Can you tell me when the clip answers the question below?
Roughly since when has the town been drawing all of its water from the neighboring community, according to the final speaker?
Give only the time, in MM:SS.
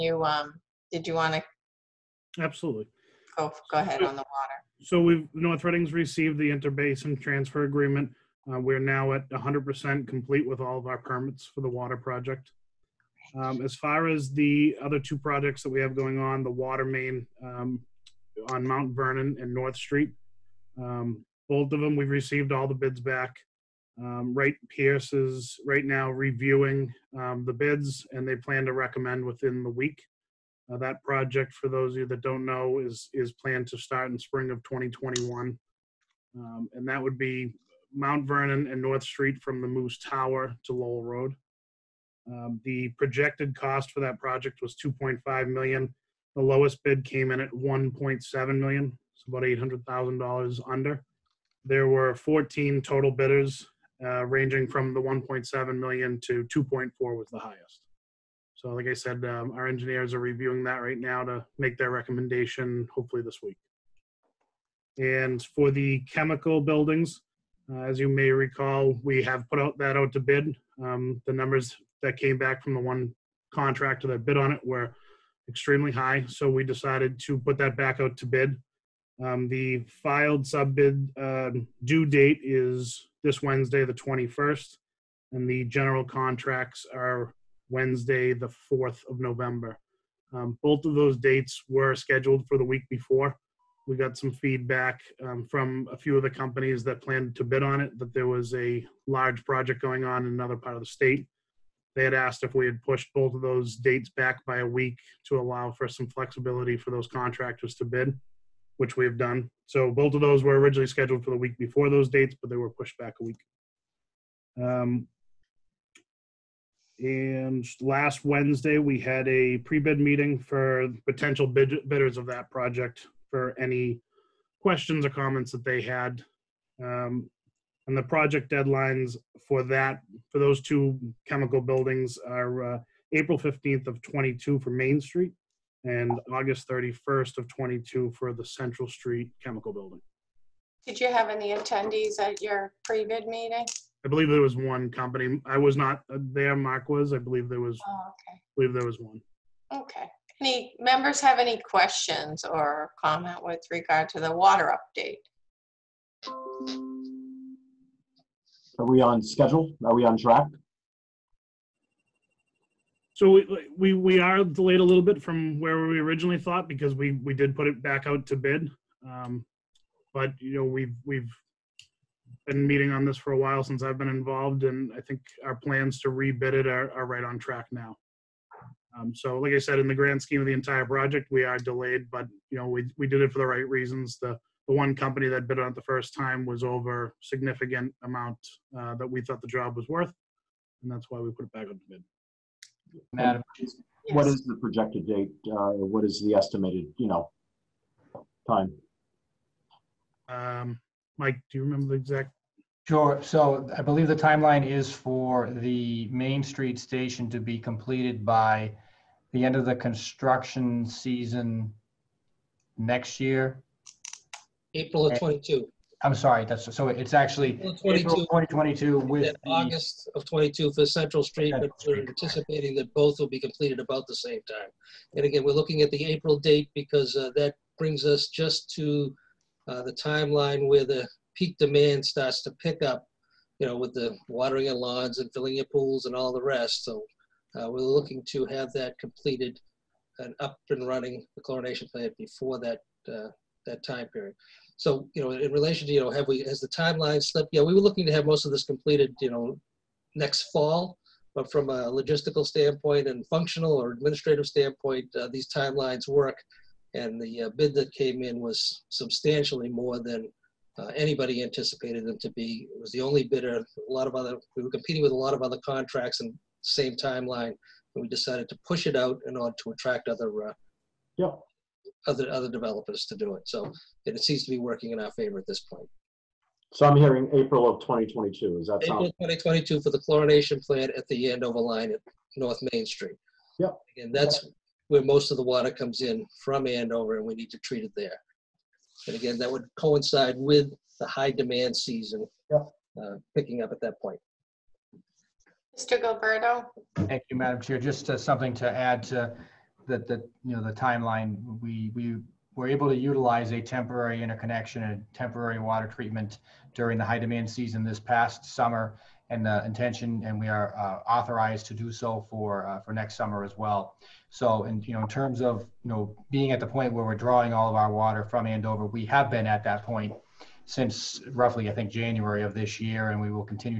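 05:21.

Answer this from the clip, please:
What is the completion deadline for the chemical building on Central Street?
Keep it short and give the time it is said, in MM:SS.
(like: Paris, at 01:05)
August 31, 2022, at 02:16.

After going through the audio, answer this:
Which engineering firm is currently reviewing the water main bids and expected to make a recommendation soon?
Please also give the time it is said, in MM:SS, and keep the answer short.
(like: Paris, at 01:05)
Wright Pierce, at 00:24.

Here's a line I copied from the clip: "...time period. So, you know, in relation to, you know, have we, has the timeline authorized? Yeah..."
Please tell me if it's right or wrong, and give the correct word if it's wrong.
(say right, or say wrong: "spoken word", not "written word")
wrong: "slipped", not "authorized".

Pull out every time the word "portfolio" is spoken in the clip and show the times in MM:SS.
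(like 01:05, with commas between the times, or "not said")
not said.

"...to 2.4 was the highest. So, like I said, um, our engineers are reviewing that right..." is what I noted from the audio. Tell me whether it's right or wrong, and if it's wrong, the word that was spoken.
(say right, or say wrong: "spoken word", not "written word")
right.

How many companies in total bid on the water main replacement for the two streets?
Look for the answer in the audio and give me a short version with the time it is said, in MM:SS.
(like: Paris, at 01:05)
14, at 00:52.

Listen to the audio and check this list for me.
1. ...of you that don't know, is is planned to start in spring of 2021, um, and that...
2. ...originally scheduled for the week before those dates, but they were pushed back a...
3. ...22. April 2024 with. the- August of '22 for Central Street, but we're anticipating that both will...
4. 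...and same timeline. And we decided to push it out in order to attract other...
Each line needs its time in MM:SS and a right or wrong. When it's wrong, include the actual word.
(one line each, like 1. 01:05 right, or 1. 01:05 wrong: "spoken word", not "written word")
1. 00:31 right
2. 01:50 right
3. 03:37 wrong: "2022", not "2024"
4. 04:26 right.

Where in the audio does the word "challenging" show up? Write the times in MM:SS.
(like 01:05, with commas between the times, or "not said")
not said.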